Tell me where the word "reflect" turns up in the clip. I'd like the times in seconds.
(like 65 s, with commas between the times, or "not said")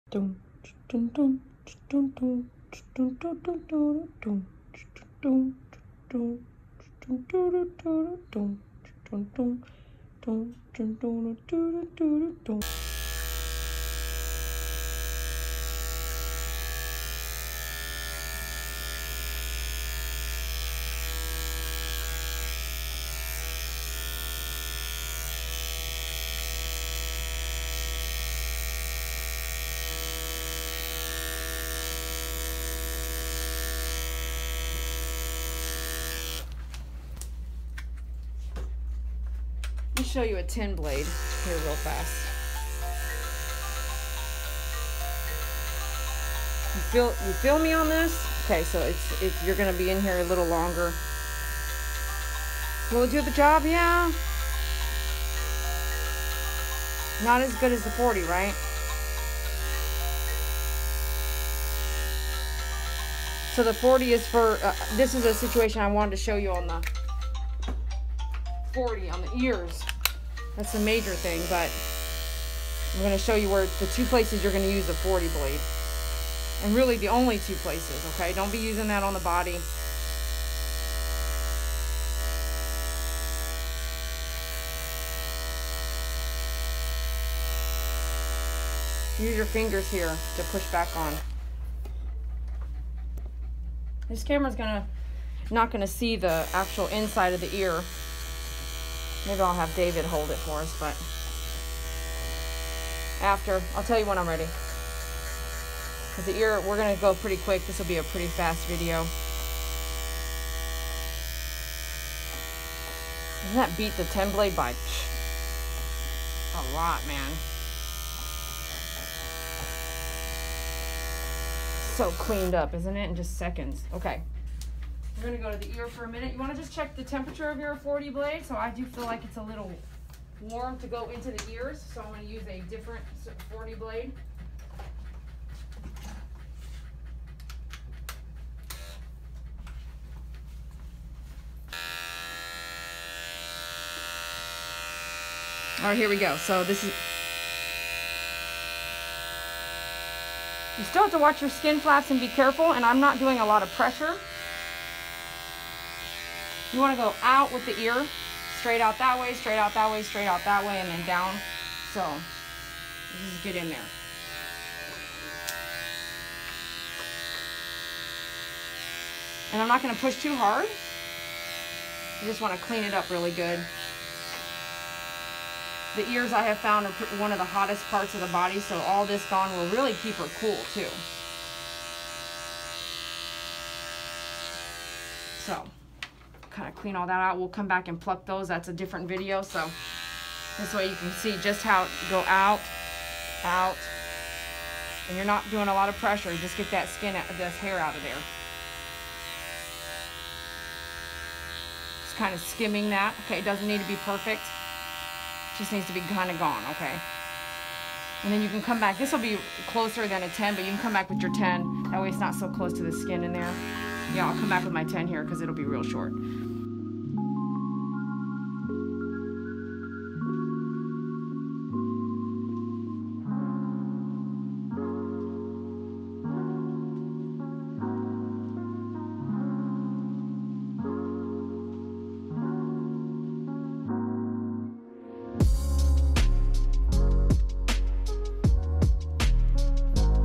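not said.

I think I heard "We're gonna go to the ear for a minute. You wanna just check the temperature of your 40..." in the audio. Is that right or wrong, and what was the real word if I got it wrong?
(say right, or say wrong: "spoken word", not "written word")
right.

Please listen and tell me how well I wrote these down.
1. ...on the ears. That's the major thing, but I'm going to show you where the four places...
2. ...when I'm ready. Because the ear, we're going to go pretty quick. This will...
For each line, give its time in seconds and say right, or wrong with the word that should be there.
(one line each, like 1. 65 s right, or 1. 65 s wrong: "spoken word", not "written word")
1. 69 s wrong: "two", not "four"
2. 104 s right.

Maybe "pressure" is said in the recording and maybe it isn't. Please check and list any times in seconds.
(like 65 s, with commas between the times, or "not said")
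153 s, 195 s.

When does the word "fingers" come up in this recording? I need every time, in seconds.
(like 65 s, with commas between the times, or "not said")
89 s.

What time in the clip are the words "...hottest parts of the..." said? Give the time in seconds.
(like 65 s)
177 s.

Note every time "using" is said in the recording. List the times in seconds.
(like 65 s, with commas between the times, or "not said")
78 s.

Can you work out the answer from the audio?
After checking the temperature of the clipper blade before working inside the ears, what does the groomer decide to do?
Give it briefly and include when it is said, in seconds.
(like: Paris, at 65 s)
Use a different 40 blade, at 132 s.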